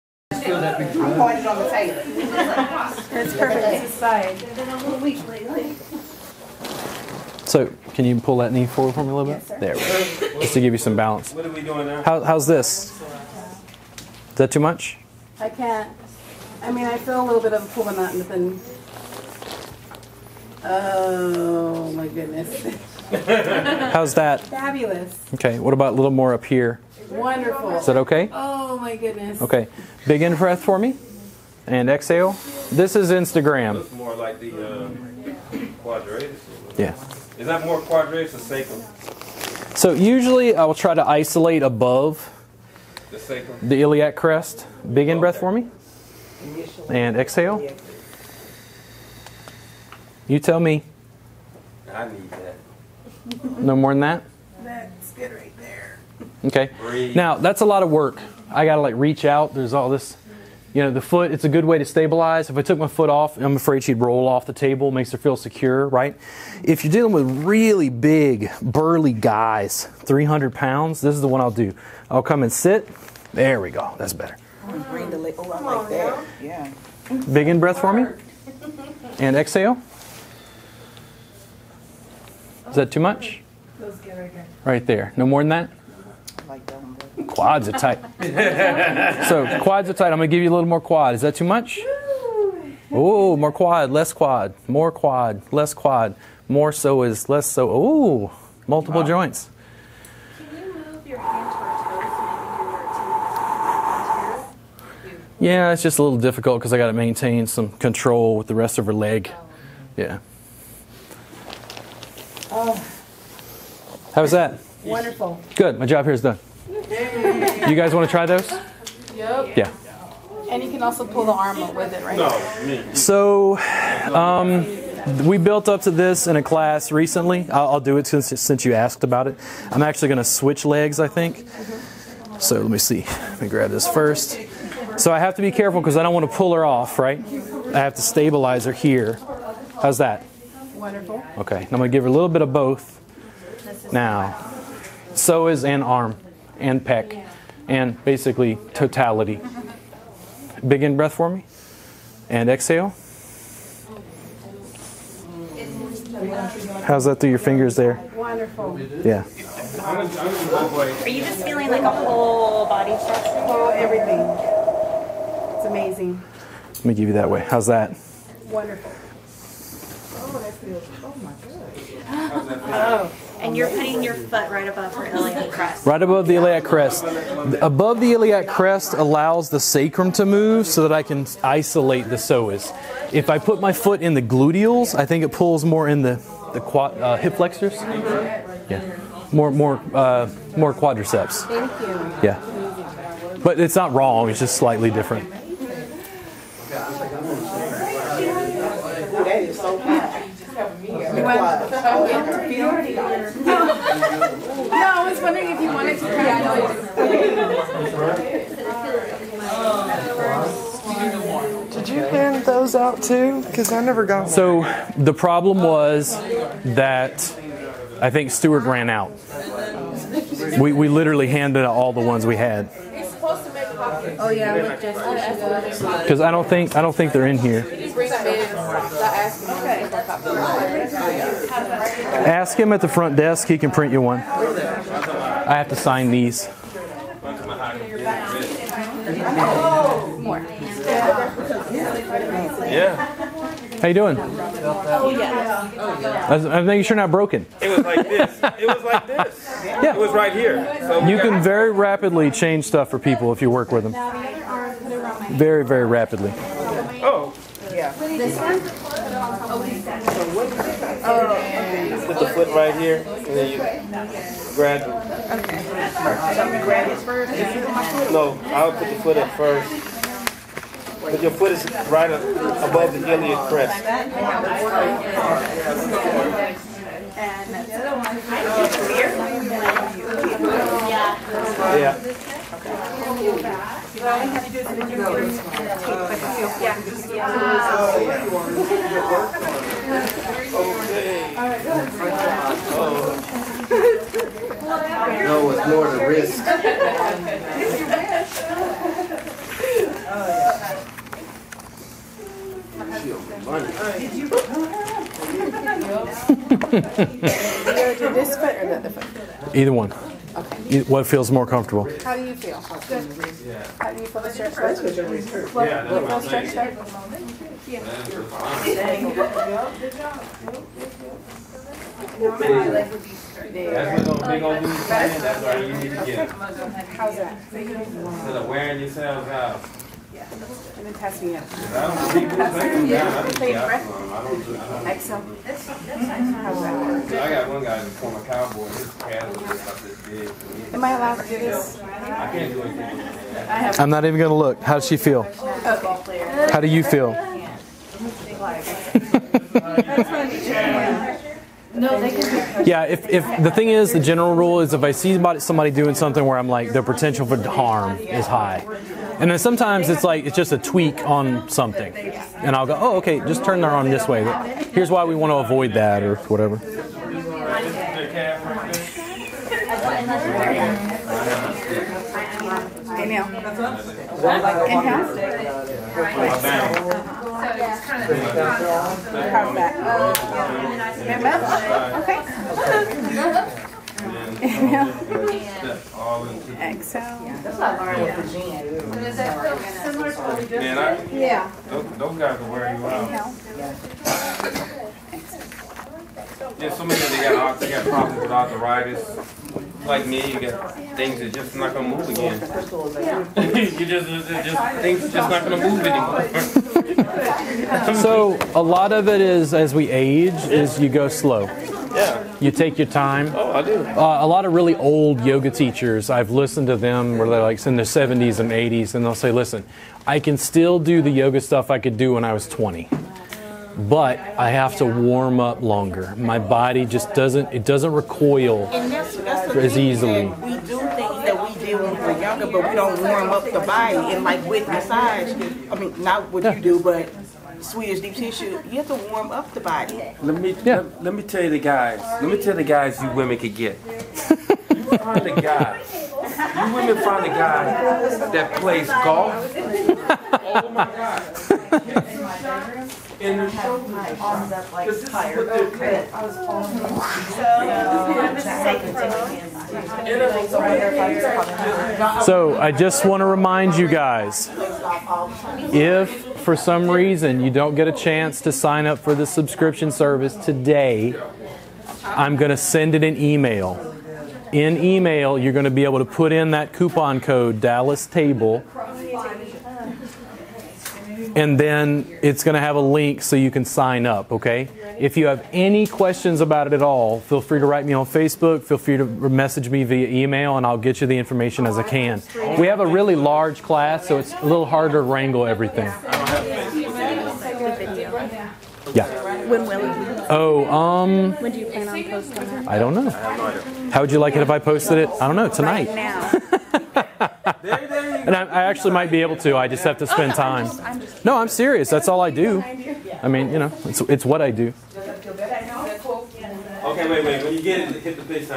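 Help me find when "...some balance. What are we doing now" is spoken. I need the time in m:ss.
0:10.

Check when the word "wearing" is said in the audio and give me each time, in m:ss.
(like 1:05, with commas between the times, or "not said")
5:28, 6:32.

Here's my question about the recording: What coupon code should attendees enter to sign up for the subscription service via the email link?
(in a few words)
Dallas Table.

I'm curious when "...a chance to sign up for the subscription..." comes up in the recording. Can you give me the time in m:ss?
7:47.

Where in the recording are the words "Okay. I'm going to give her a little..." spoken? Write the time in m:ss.
2:21.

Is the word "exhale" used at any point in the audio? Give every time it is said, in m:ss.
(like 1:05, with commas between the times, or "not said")
0:31, 0:47, 1:19, 2:32, 6:26.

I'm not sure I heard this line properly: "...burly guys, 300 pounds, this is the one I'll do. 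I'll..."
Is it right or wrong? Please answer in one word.
right.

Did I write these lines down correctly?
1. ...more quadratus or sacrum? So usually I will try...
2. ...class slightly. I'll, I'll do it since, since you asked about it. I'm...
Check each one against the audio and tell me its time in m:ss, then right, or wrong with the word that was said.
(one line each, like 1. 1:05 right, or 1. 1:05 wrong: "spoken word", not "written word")
1. 0:37 right
2. 2:06 wrong: "recently", not "slightly".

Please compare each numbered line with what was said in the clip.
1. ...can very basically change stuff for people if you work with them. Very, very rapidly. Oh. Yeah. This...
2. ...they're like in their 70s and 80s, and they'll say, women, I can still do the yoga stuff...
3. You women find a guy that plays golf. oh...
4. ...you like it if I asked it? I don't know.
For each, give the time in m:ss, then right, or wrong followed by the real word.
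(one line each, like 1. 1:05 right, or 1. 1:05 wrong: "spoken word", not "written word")
1. 4:11 wrong: "rapidly", not "basically"
2. 6:57 wrong: "listen", not "women"
3. 7:25 right
4. 8:24 wrong: "posted", not "asked".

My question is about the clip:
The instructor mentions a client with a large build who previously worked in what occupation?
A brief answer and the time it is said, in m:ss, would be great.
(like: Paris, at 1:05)
cowboy, at 5:38.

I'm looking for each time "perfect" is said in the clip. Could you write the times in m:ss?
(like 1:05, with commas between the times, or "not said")
0:03, 6:21.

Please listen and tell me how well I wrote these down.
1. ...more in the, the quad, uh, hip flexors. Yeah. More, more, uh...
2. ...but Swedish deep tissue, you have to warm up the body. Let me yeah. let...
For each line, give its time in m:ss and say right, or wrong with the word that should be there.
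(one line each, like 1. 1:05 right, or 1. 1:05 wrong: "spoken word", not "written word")
1. 3:05 right
2. 7:16 right.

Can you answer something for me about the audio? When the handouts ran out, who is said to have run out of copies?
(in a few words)
Stewart.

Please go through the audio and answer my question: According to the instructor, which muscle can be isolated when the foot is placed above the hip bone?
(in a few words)
psoas.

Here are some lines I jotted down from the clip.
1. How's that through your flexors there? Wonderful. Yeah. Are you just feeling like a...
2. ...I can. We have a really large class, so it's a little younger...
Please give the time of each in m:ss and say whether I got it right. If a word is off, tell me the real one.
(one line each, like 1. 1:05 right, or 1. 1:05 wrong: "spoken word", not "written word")
1. 2:36 wrong: "fingers", not "flexors"
2. 8:11 wrong: "harder", not "younger".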